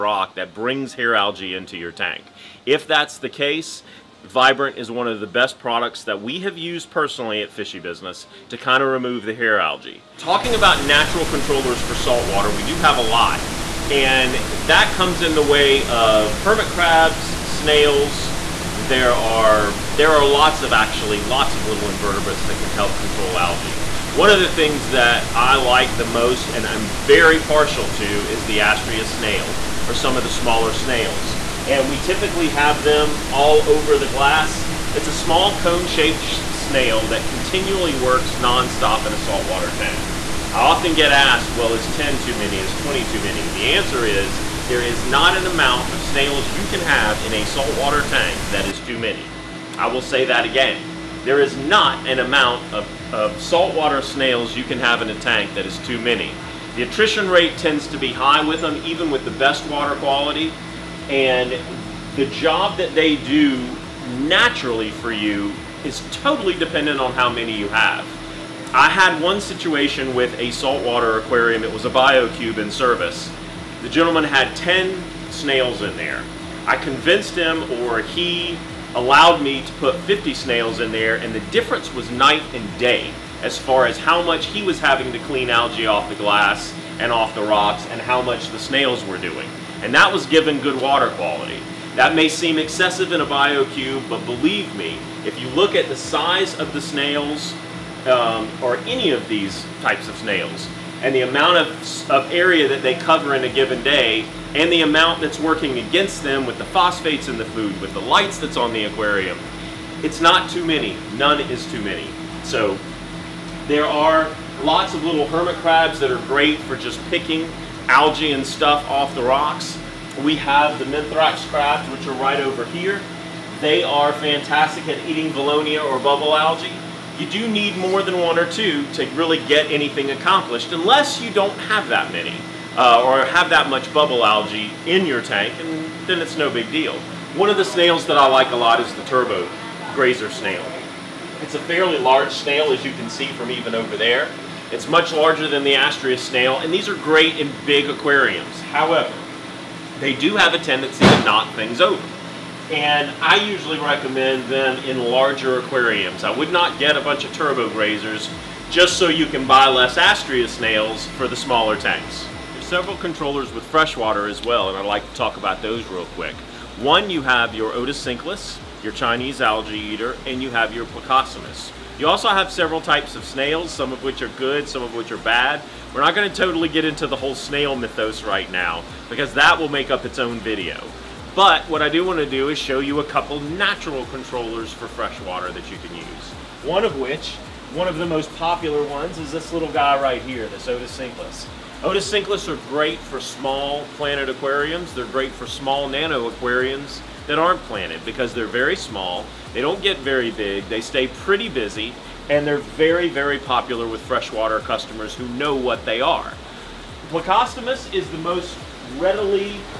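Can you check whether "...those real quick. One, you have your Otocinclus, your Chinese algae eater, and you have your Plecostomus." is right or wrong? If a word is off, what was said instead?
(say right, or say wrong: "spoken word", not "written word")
right.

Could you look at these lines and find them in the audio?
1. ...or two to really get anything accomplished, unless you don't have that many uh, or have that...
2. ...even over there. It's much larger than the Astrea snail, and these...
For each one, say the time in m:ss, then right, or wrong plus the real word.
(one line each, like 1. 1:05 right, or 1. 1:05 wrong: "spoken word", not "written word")
1. 2:08 right
2. 2:23 right.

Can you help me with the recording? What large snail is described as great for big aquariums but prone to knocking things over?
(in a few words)
Turbo grazer snail.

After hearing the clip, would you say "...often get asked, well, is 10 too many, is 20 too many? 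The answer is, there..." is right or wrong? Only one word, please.
right.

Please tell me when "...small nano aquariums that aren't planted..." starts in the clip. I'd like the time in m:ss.
3:15.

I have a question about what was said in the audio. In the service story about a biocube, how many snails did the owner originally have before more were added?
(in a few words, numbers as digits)
10.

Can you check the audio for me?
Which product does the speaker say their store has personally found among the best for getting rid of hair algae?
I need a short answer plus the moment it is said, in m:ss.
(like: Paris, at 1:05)
Vibrant, at 0:04.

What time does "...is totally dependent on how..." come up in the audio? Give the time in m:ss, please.
1:05.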